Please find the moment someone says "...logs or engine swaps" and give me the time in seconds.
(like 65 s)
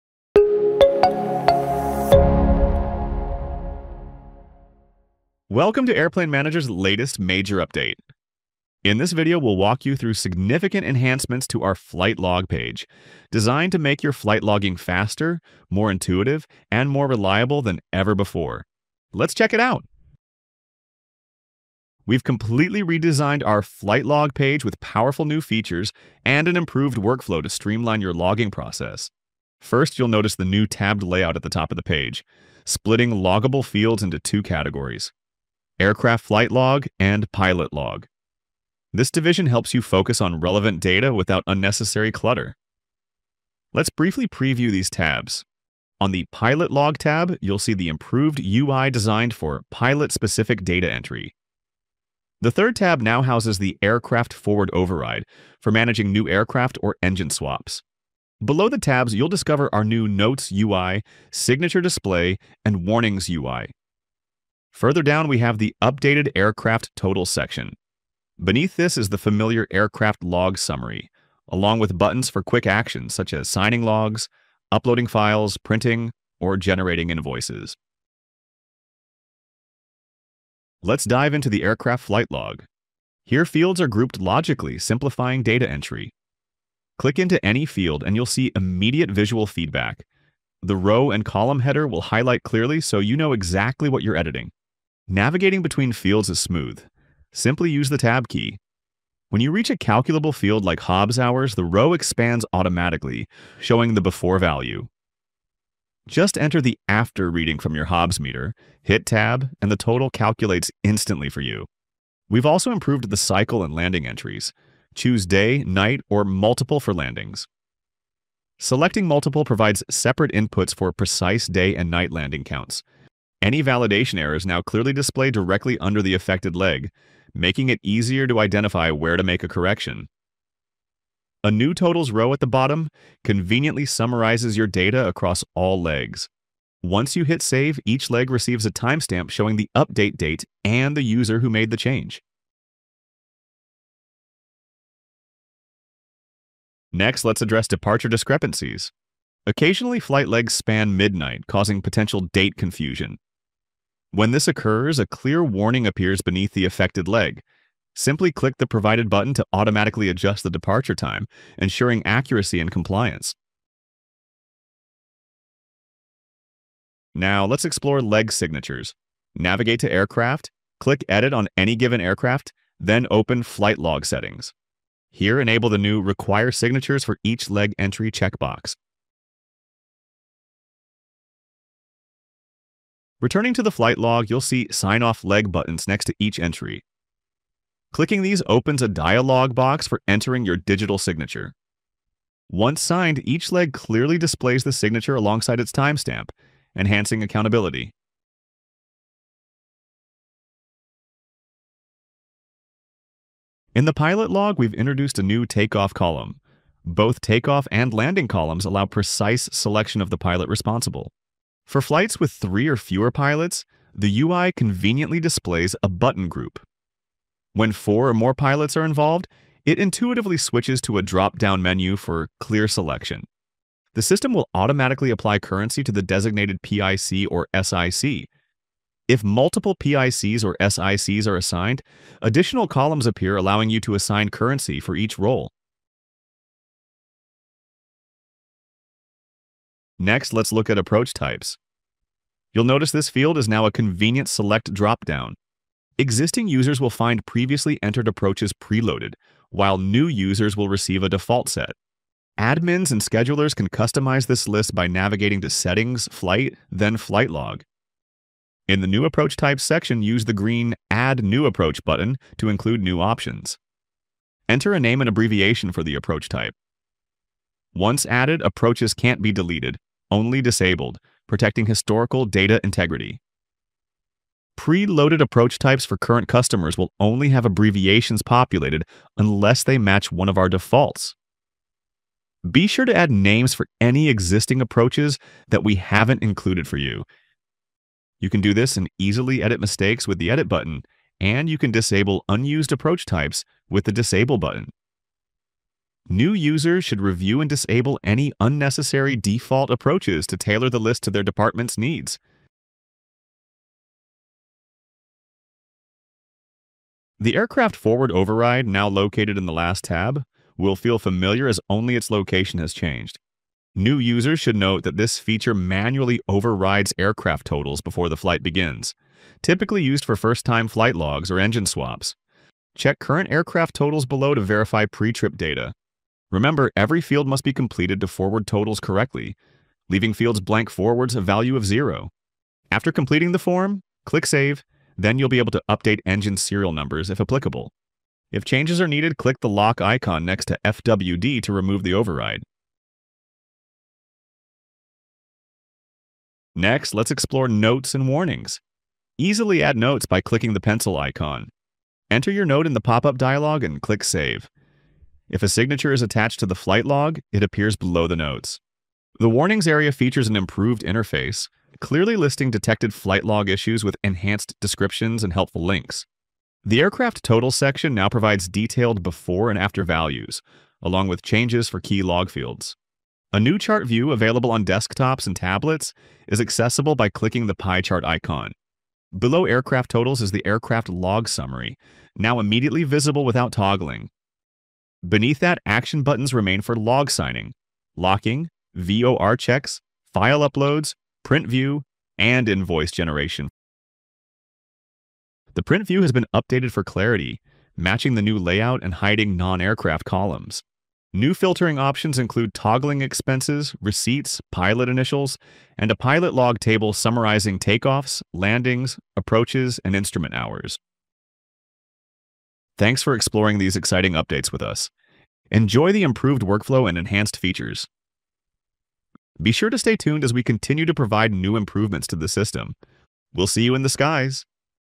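320 s.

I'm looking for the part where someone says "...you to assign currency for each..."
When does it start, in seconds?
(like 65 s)
233 s.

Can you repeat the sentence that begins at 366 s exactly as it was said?
The aircraft total section now provides detailed before and after values, along with changes for key log fields.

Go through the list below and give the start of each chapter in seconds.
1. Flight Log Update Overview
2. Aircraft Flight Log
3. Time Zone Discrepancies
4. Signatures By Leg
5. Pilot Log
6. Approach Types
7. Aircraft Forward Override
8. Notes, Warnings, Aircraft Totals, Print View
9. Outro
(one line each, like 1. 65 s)
1. 20 s
2. 79 s
3. 144 s
4. 165 s
5. 200 s
6. 238 s
7. 305 s
8. 345 s
9. 410 s.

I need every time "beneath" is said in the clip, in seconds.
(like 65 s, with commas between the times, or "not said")
68 s, 156 s, 385 s.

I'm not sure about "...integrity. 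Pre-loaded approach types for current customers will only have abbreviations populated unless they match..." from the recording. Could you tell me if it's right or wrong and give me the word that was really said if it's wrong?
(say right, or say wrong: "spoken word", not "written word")
right.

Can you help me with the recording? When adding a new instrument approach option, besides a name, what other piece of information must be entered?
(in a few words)
Abbreviation.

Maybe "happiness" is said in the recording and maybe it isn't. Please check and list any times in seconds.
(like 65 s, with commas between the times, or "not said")
not said.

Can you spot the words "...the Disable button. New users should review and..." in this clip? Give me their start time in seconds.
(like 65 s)
293 s.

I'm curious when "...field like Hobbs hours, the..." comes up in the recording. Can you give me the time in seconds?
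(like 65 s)
100 s.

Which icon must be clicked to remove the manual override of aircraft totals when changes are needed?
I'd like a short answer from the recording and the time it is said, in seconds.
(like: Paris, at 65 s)
Lock icon, at 339 s.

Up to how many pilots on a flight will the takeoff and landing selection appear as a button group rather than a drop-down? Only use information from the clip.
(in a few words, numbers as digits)
3.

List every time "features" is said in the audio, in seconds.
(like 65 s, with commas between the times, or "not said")
25 s, 315 s, 359 s, 417 s.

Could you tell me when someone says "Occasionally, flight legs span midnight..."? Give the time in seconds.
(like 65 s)
149 s.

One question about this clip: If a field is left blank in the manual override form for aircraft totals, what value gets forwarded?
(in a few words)
0.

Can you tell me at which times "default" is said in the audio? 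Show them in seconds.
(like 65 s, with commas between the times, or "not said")
251 s, 280 s, 299 s.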